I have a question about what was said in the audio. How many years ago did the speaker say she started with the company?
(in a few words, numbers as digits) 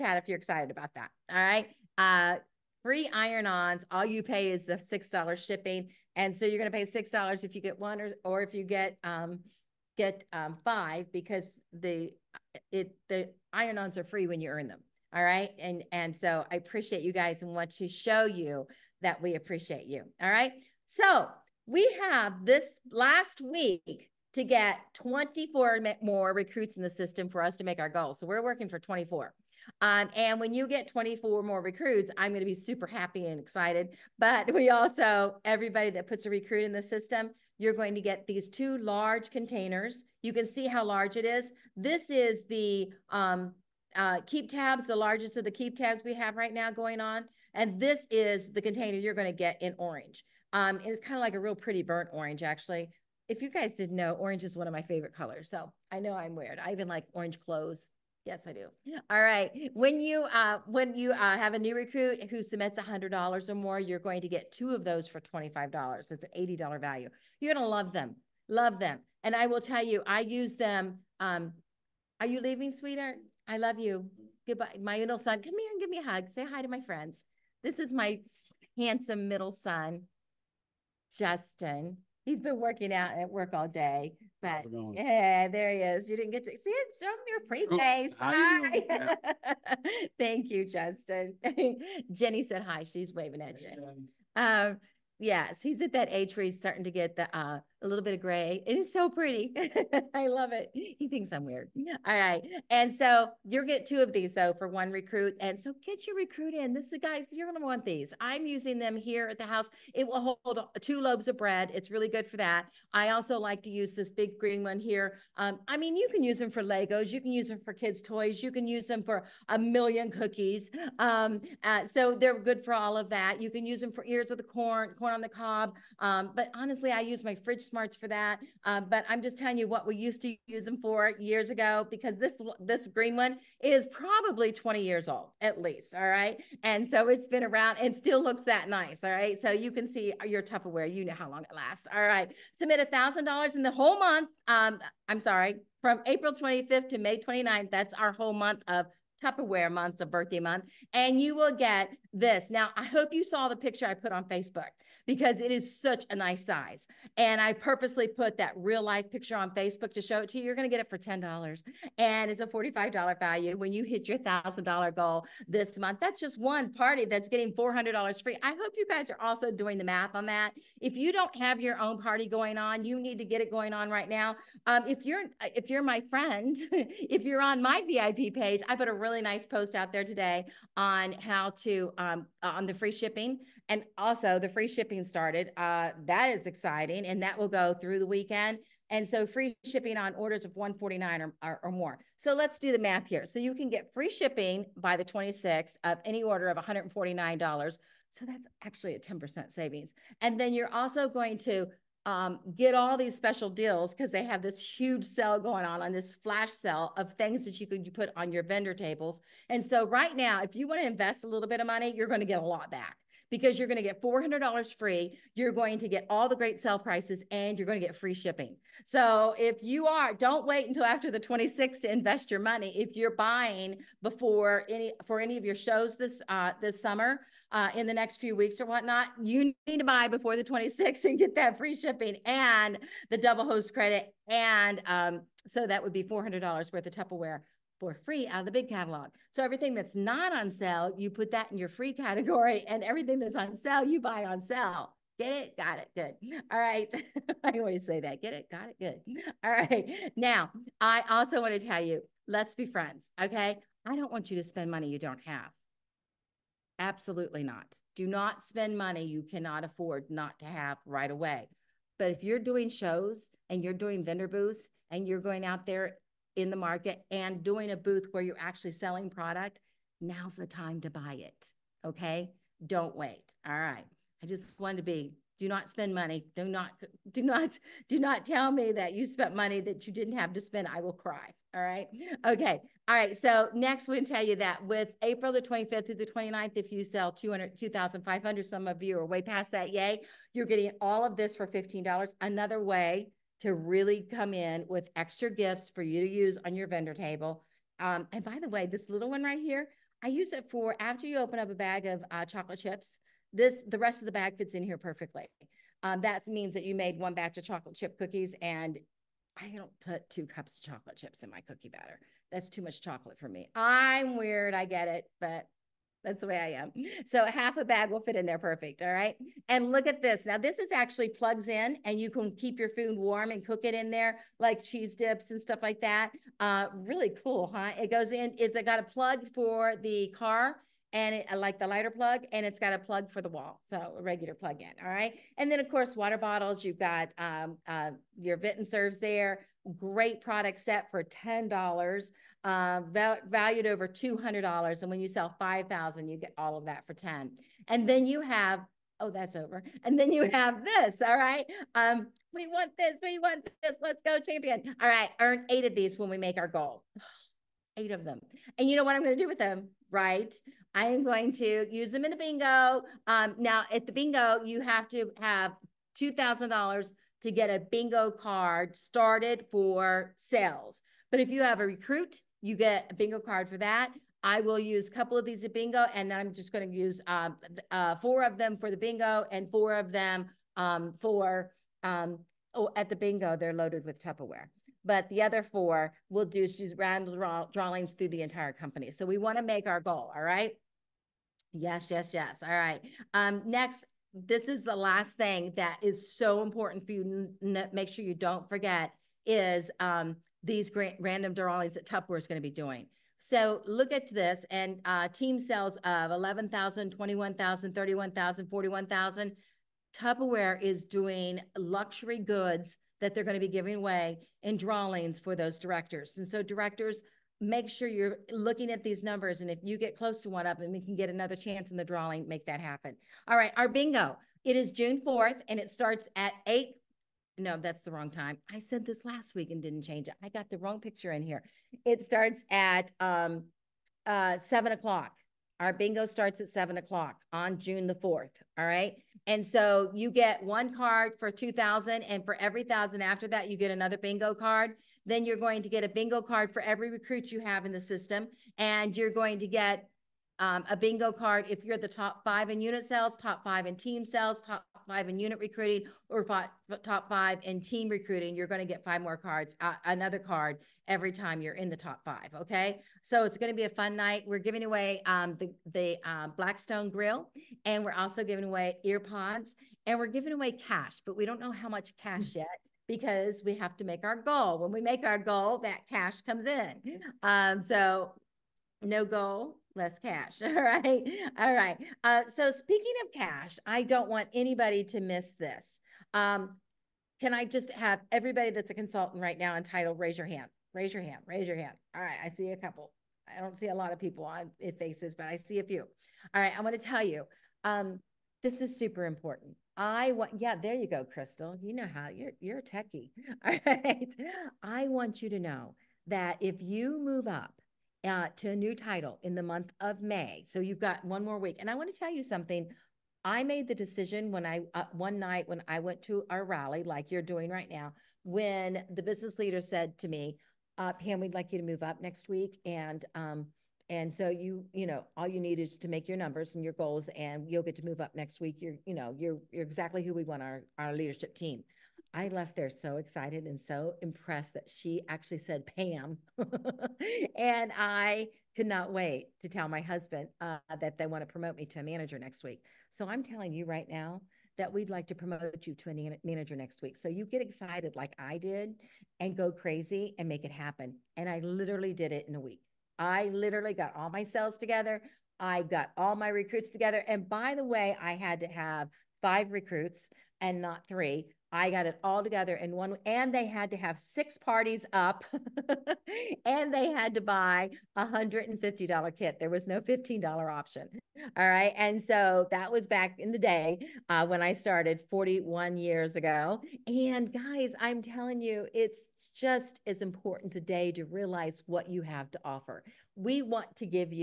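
41.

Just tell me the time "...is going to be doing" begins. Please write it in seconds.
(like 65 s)
402 s.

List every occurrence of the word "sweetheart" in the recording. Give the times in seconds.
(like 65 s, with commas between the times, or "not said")
72 s.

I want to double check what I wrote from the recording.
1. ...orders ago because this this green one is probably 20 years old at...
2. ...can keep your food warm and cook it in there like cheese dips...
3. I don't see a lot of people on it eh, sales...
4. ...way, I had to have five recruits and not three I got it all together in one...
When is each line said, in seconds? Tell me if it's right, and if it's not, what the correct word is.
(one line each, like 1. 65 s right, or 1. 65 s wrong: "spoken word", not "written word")
1. 131 s wrong: "years", not "orders"
2. 322 s right
3. 493 s wrong: "faces", not "sales"
4. 557 s right.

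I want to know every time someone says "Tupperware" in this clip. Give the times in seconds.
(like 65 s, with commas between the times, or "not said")
140 s, 149 s, 236 s, 384 s, 401 s, 409 s.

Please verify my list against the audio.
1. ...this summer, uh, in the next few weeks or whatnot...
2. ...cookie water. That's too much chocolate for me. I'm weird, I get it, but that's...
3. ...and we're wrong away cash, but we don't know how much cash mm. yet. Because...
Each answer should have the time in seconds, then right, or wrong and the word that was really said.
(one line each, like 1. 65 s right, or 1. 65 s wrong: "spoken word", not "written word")
1. 226 s right
2. 311 s wrong: "batter", not "water"
3. 469 s wrong: "giving", not "wrong".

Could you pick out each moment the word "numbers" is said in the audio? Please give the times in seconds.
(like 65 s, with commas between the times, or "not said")
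419 s, 526 s.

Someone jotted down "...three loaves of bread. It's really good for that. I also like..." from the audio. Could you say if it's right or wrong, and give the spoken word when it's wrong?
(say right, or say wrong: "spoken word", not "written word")
wrong: "two", not "three".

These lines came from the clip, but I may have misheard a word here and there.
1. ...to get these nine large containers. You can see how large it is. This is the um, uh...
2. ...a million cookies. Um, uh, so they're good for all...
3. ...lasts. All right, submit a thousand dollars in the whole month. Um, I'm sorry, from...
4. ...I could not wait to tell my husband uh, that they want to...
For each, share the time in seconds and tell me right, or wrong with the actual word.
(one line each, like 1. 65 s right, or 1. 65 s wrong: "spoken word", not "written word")
1. 37 s wrong: "two", not "nine"
2. 119 s right
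3. 141 s right
4. 537 s right.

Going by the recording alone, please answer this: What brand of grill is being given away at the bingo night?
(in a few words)
Blackstone.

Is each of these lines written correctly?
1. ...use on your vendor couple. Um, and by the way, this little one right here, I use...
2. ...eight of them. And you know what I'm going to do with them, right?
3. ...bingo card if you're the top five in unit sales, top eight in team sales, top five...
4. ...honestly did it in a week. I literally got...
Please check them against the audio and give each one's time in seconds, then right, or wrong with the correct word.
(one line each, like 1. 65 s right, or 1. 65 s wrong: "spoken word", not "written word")
1. 296 s wrong: "table", not "couple"
2. 357 s right
3. 450 s wrong: "five", not "eight"
4. 551 s wrong: "literally", not "honestly".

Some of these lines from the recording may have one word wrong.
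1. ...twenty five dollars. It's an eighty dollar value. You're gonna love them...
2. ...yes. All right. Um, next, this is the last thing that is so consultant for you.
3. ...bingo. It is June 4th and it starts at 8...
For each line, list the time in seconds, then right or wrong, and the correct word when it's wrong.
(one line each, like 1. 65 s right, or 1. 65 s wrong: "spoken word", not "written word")
1. 65 s right
2. 392 s wrong: "important", not "consultant"
3. 423 s right.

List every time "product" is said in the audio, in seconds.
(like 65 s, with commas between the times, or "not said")
269 s, 340 s.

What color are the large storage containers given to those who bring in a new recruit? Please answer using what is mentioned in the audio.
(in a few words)
Burnt orange.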